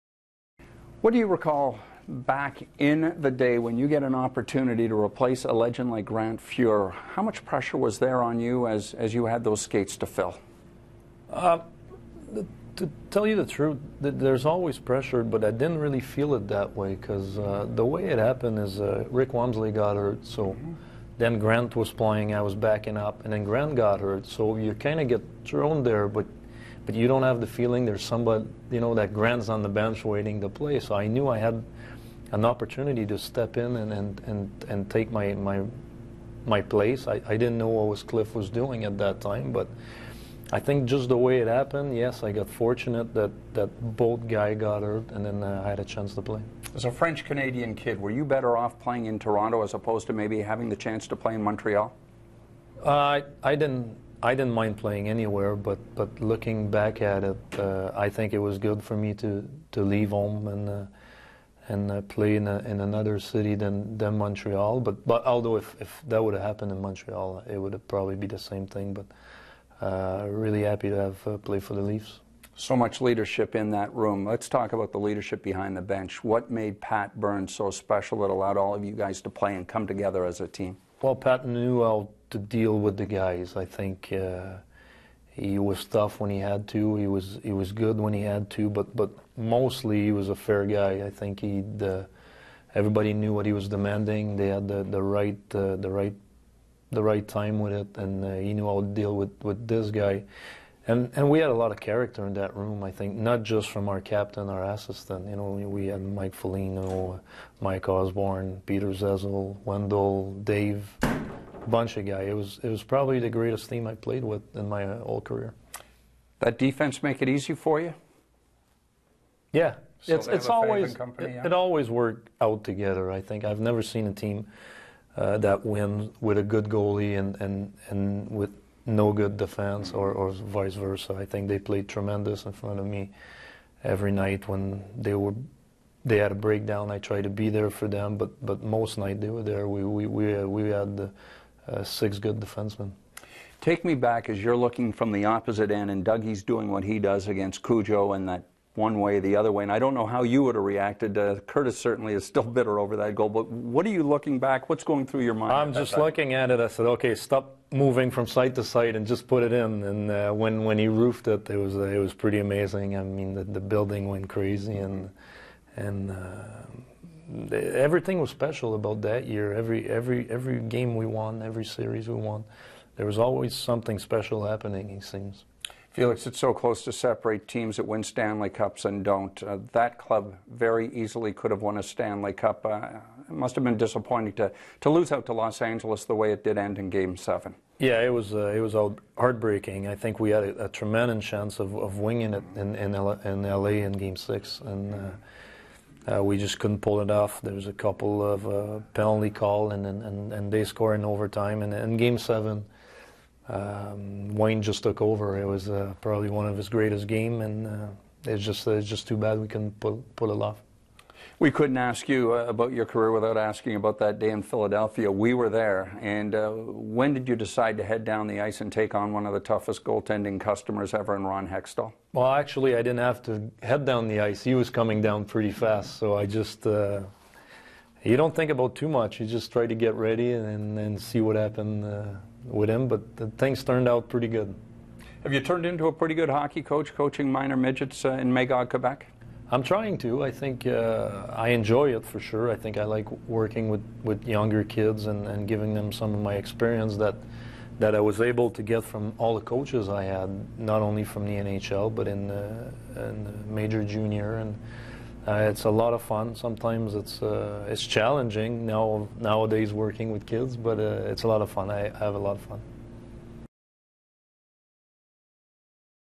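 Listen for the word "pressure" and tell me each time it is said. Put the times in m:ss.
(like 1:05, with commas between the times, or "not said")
0:07, 0:14.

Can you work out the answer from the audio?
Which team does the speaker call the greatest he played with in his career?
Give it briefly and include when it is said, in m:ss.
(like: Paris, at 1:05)
the Leafs, at 1:11.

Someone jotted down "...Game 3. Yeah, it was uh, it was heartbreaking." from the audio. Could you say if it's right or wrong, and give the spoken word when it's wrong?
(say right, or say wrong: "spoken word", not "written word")
wrong: "7", not "3".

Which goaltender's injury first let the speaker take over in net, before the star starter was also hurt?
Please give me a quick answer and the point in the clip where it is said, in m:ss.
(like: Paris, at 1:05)
Rick Wamsley, at 0:19.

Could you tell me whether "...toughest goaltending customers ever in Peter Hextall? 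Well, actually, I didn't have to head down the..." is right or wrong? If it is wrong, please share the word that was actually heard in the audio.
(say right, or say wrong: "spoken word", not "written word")
wrong: "Ron", not "Peter".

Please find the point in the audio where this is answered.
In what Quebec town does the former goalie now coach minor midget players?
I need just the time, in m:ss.
3:58.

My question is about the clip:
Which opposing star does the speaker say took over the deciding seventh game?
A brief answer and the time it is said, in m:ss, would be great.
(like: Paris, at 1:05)
Wayne, at 3:24.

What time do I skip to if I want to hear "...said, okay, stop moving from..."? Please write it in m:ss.
2:36.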